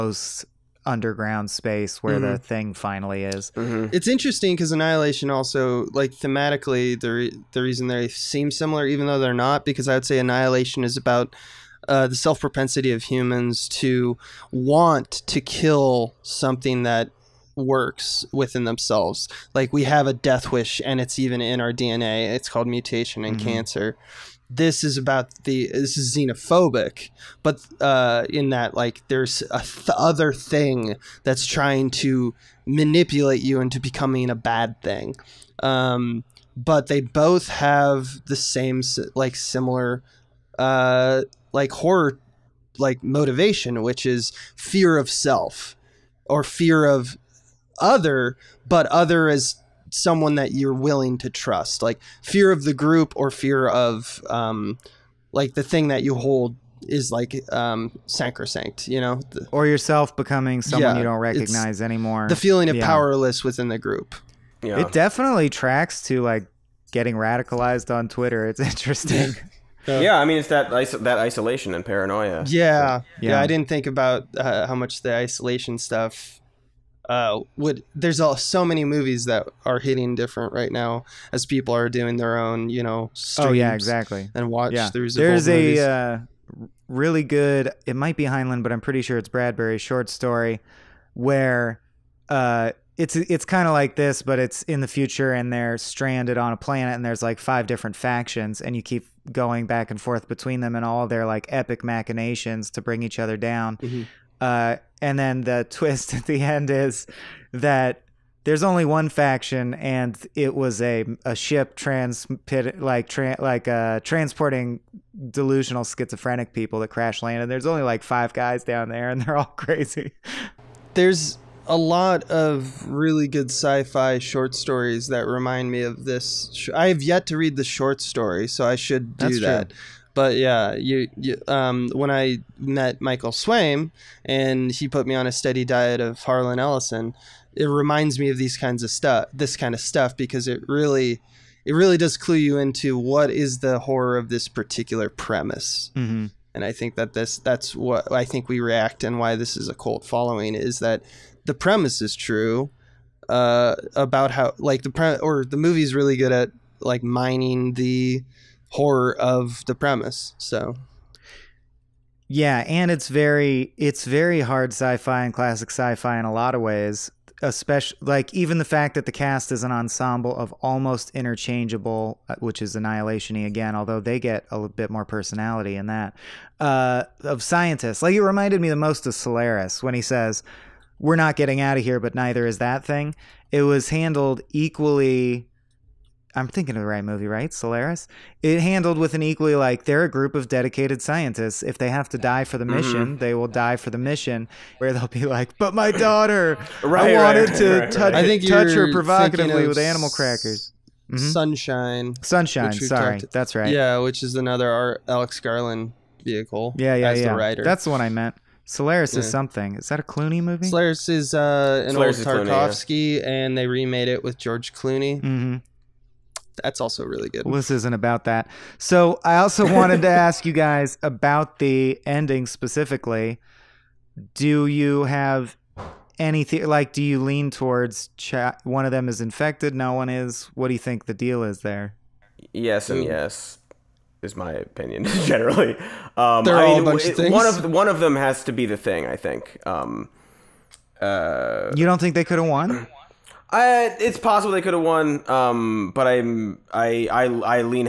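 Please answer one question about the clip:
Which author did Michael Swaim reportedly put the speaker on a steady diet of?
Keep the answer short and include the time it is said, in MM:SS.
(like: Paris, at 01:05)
Harlan Ellison, at 02:16.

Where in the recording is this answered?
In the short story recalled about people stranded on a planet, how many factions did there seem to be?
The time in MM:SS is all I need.
01:37.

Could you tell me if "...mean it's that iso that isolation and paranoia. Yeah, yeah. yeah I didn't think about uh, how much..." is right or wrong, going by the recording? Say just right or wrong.
right.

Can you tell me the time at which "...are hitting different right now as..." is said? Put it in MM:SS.
01:19.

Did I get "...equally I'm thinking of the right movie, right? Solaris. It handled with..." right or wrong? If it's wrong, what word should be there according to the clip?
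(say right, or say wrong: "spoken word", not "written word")
right.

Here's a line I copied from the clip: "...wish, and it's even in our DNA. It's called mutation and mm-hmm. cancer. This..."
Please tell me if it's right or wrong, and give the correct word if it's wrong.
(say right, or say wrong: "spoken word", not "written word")
right.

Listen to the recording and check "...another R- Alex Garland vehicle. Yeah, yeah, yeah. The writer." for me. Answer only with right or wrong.
right.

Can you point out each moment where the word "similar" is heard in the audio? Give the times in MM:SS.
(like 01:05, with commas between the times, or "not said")
00:08, 00:39.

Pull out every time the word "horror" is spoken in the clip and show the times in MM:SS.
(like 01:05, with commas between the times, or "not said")
00:41, 02:23, 02:38.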